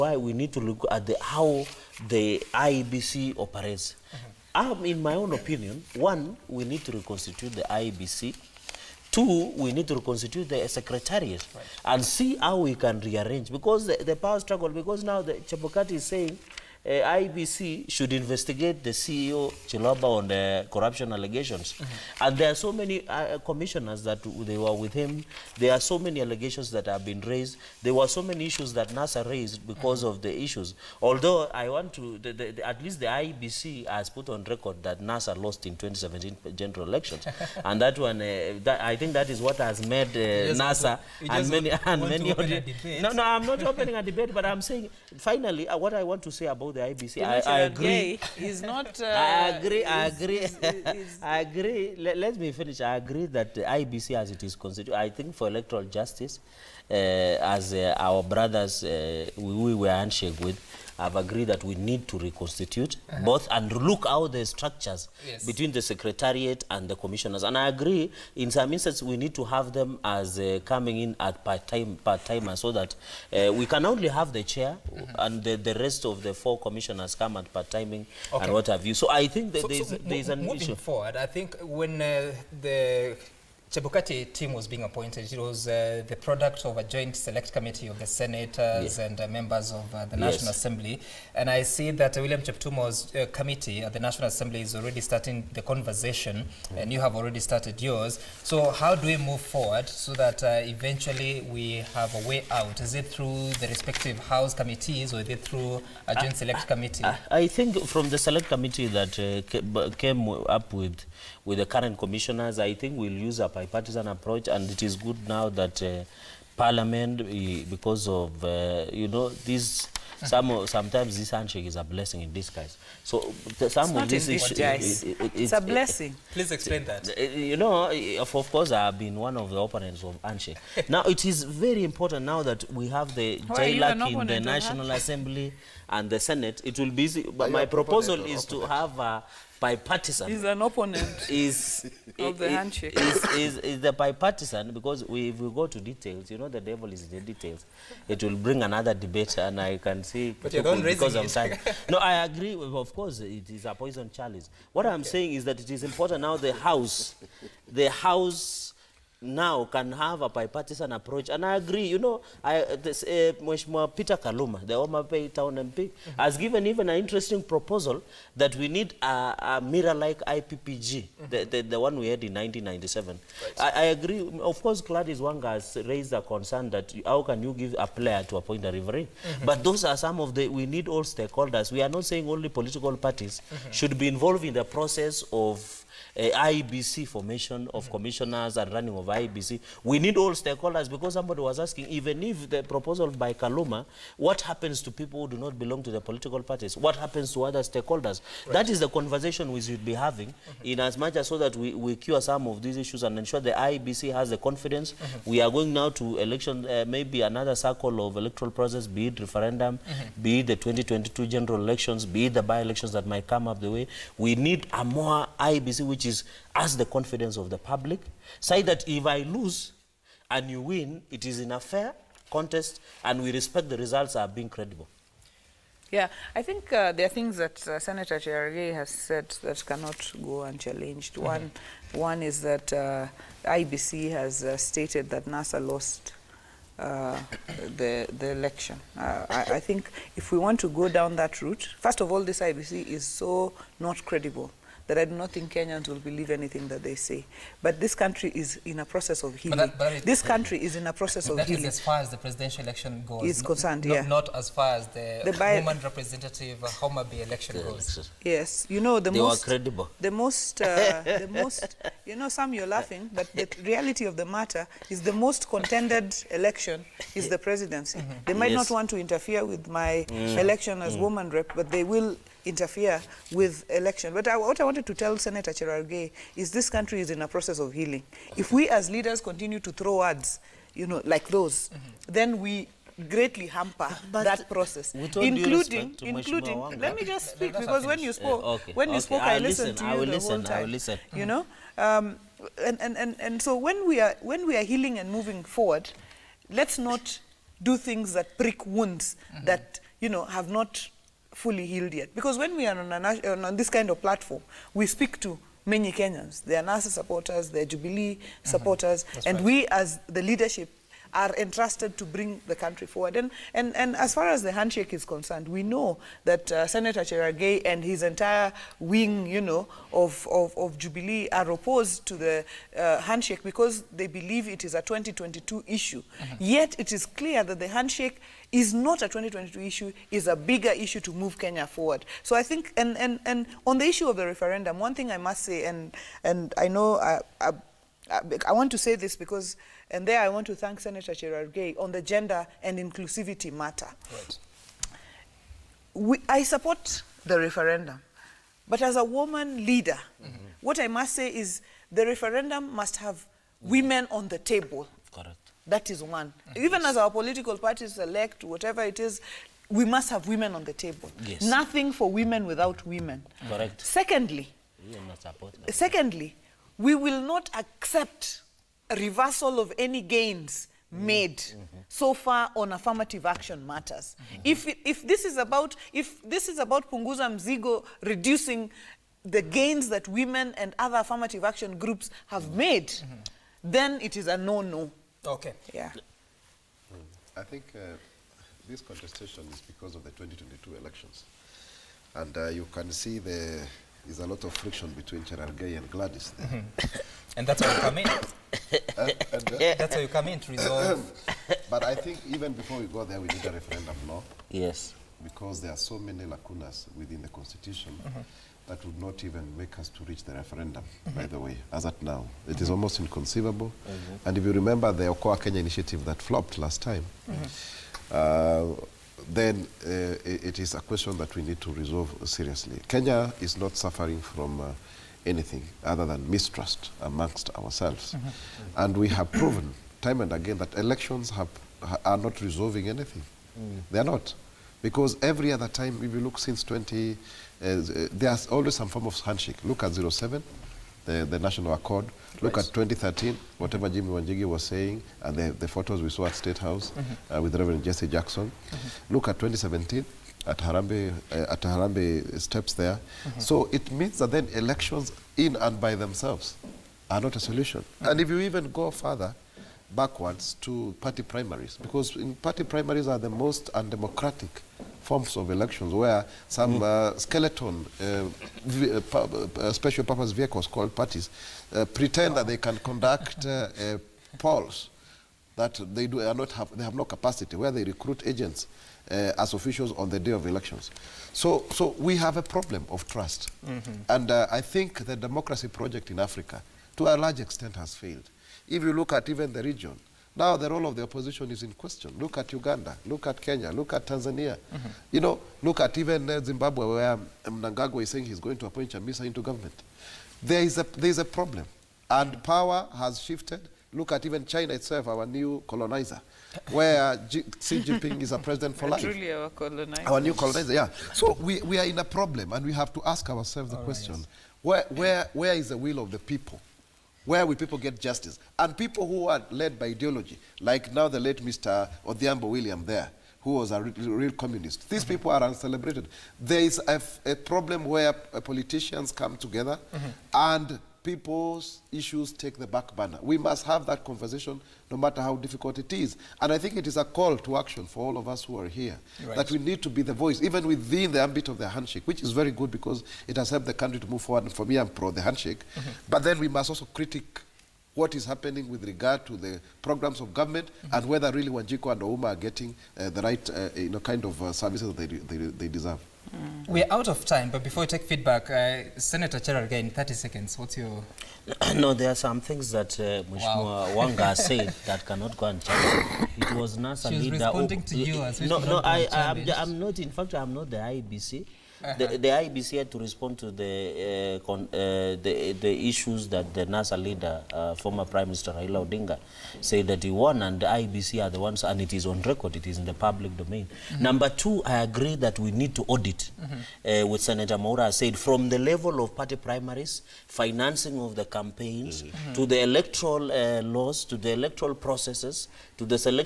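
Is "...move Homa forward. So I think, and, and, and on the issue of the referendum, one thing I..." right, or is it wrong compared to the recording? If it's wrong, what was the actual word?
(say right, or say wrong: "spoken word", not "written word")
wrong: "Kenya", not "Homa".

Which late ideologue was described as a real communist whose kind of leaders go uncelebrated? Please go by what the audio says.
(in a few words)
Odhiambo William.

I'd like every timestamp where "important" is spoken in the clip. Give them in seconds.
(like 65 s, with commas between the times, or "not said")
131 s, 155 s.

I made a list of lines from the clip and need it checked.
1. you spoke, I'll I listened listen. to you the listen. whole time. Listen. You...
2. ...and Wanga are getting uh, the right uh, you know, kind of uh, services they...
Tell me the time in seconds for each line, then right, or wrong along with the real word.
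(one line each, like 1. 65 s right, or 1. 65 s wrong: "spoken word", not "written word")
1. 288 s right
2. 551 s wrong: "Ouma", not "Wanga".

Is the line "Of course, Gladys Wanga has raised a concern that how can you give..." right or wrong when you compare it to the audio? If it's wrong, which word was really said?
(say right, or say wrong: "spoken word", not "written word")
right.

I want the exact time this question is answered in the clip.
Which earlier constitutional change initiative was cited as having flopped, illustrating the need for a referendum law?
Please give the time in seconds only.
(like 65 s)
415 s.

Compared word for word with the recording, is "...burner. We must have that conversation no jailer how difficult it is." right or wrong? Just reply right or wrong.
wrong.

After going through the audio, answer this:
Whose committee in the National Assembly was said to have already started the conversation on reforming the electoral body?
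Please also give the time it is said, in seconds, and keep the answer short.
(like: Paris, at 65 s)
William Cheptumo, at 92 s.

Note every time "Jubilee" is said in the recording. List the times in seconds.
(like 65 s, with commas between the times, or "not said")
307 s, 320 s.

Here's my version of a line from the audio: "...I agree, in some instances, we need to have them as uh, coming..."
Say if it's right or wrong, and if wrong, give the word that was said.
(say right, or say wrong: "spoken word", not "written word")
right.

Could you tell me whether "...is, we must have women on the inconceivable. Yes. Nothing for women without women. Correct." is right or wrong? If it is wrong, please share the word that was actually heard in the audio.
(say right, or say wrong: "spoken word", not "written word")
wrong: "table", not "inconceivable".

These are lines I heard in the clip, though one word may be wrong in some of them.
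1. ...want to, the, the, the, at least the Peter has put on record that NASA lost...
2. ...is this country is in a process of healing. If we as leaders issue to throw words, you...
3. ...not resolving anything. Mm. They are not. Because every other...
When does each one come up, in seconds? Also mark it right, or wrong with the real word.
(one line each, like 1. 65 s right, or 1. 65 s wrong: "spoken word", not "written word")
1. 31 s wrong: "IEBC", not "Peter"
2. 276 s wrong: "continue", not "issue"
3. 432 s right.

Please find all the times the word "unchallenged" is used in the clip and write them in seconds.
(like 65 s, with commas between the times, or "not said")
230 s, 565 s.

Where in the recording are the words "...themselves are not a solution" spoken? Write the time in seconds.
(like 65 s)
455 s.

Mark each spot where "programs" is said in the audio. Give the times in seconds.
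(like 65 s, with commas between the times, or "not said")
549 s.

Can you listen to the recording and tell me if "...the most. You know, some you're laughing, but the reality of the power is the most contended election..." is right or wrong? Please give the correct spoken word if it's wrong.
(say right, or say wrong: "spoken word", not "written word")
wrong: "matter", not "power".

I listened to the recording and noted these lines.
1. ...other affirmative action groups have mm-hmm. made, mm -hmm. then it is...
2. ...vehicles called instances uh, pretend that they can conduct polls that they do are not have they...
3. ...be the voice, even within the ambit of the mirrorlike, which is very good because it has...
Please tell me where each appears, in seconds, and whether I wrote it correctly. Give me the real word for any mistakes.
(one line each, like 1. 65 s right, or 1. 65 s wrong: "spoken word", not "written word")
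1. 380 s right
2. 470 s wrong: "parties", not "instances"
3. 539 s wrong: "handshake", not "mirrorlike".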